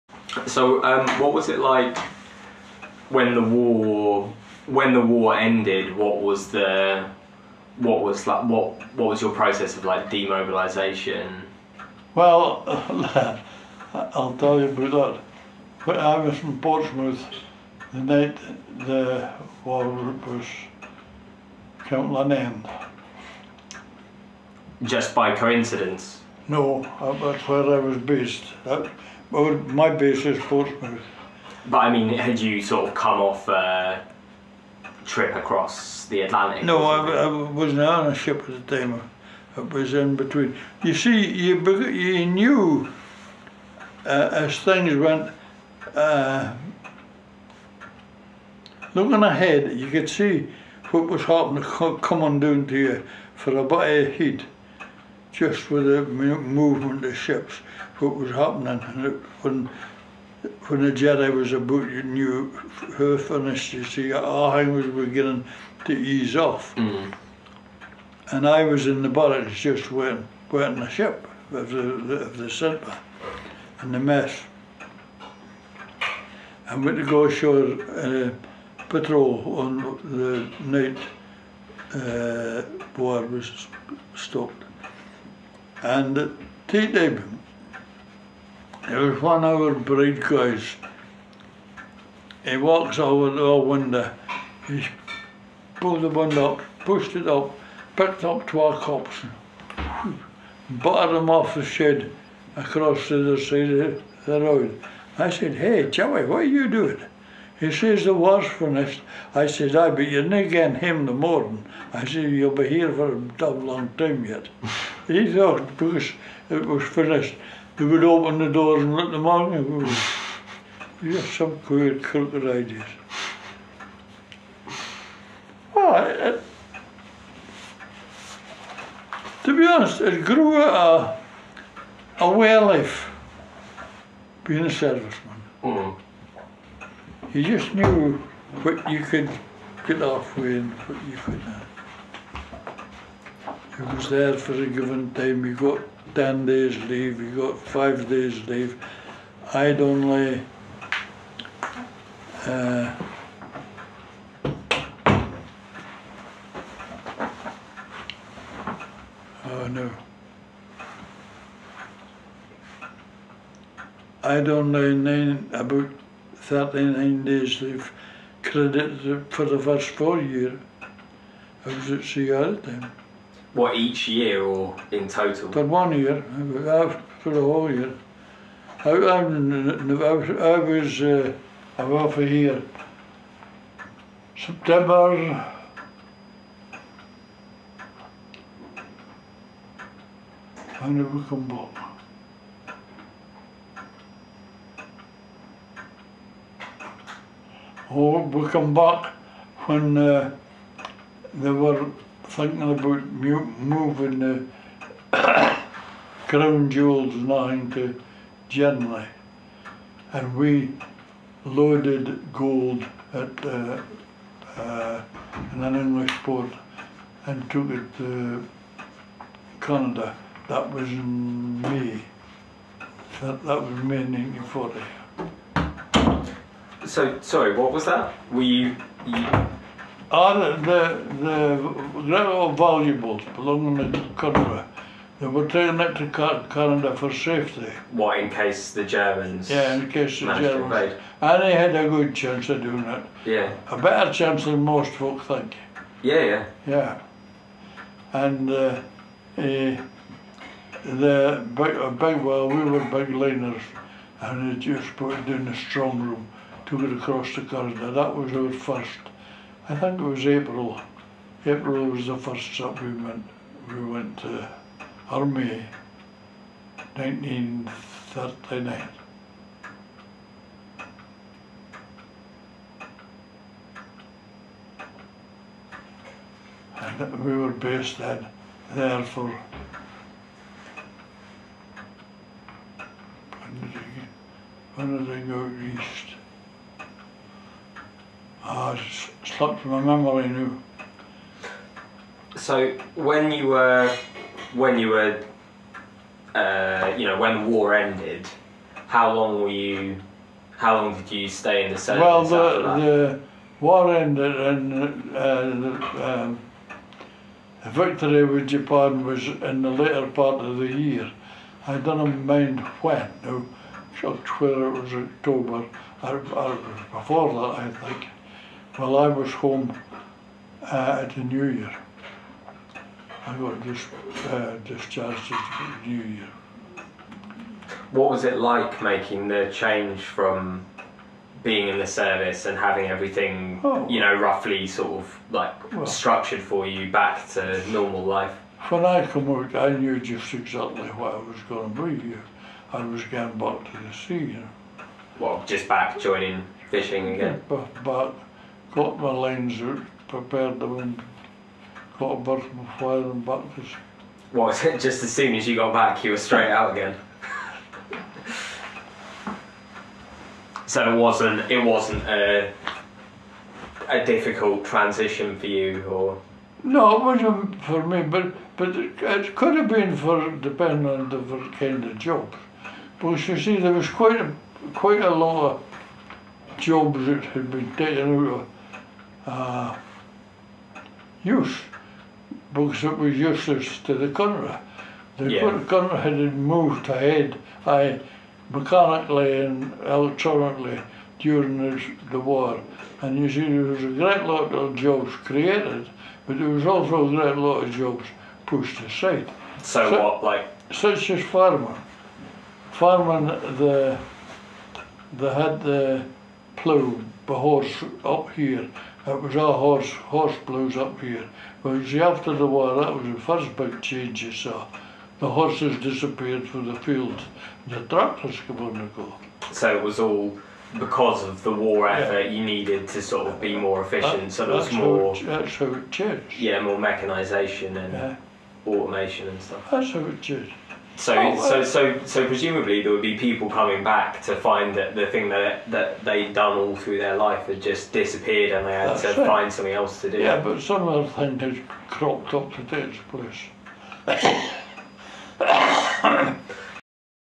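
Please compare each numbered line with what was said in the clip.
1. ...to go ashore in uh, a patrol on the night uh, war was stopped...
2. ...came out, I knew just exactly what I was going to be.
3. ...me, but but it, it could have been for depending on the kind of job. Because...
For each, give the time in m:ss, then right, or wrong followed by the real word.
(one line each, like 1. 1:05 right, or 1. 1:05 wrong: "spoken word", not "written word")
1. 1:16 right
2. 5:39 right
3. 6:07 right.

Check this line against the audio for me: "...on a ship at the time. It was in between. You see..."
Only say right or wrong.
right.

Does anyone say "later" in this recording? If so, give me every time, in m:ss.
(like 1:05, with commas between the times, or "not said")
5:09.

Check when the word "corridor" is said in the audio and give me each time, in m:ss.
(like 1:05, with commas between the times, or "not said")
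4:17.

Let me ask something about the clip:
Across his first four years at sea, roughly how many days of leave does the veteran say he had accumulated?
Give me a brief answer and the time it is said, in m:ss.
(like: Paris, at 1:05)
39, at 2:46.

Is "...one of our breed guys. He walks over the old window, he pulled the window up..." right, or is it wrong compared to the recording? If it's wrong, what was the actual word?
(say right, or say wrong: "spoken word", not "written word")
right.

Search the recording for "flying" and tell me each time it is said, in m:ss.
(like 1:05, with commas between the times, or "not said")
5:52.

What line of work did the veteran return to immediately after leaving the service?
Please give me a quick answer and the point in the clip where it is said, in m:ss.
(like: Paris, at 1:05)
fishing, at 5:46.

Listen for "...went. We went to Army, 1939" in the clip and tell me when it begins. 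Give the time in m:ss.
4:22.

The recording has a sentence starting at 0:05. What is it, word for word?
What was the what was like what what was your process of like demobilization?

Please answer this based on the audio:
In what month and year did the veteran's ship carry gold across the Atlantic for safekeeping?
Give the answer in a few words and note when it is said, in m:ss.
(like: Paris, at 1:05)
May 1940, at 3:43.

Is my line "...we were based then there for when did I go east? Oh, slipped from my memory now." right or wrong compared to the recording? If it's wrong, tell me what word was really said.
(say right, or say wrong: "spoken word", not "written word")
right.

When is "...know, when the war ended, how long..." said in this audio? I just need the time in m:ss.
4:57.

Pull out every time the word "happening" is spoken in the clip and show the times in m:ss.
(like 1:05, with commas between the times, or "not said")
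0:51, 0:58.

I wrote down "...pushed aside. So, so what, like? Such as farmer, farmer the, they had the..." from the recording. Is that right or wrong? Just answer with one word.
right.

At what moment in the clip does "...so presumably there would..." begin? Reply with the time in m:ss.
7:12.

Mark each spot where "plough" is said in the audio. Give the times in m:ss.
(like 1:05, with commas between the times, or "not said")
6:46.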